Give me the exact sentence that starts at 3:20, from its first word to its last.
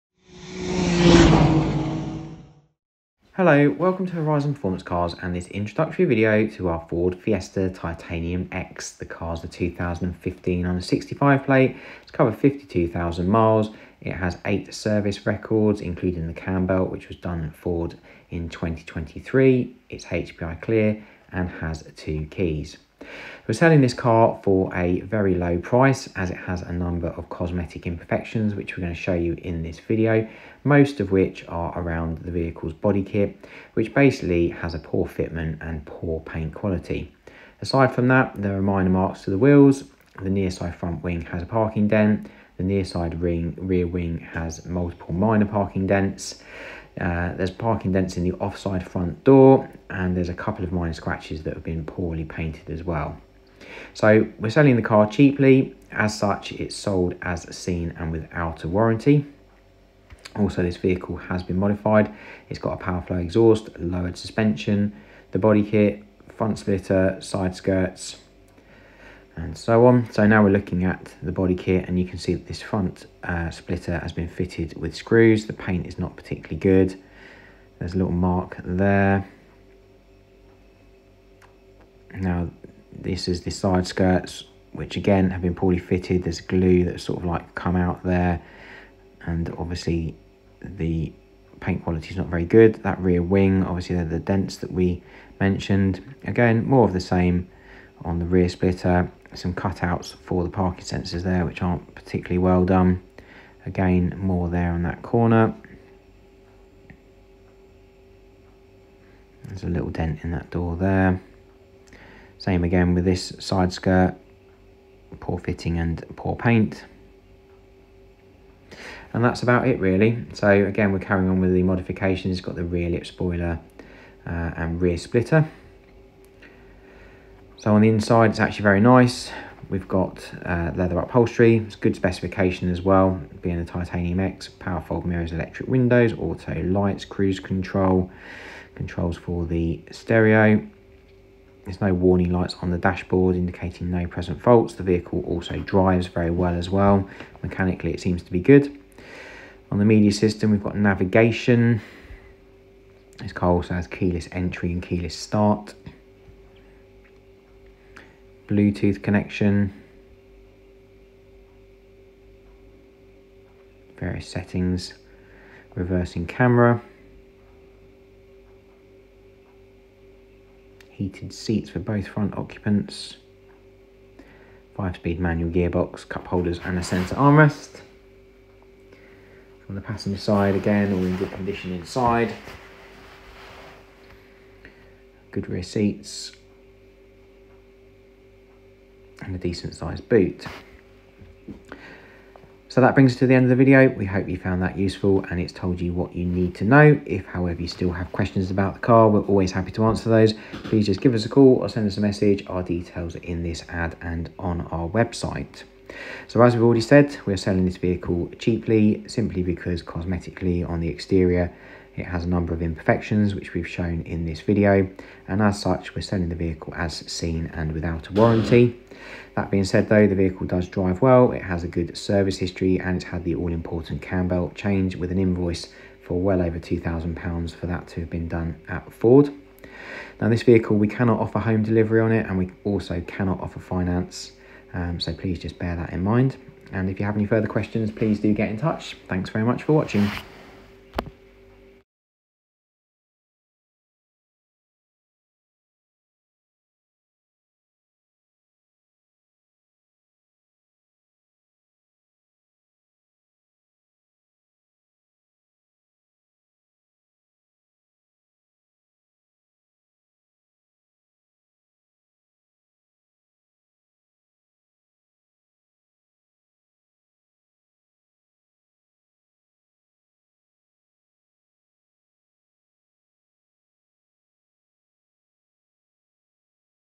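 Please just give us a call or send us a message.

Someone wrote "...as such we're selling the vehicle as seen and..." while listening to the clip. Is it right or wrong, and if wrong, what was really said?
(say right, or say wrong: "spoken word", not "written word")
right.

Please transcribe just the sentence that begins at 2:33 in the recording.
This car also has keyless entry and keyless start.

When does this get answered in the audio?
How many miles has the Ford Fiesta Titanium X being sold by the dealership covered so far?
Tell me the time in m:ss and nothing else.
0:12.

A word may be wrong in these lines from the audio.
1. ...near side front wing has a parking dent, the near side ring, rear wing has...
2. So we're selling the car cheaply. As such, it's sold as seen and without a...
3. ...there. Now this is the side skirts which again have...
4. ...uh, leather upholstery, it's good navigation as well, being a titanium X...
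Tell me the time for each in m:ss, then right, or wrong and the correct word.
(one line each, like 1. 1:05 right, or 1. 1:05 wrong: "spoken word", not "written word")
1. 0:40 right
2. 0:53 right
3. 1:18 right
4. 2:10 wrong: "specification", not "navigation".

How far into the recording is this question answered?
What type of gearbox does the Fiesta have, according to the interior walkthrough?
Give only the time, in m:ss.
2:54.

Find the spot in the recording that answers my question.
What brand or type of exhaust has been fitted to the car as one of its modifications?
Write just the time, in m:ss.
1:02.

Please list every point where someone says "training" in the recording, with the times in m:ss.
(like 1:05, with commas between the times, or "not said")
not said.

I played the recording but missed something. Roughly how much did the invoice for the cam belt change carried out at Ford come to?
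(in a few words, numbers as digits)
Over £2,000.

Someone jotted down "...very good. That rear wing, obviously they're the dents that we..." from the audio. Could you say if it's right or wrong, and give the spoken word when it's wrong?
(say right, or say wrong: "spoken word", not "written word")
right.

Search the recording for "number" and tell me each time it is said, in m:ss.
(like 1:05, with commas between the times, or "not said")
0:26, 3:32.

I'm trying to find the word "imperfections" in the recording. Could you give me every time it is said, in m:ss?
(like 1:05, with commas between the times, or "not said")
0:27, 3:32.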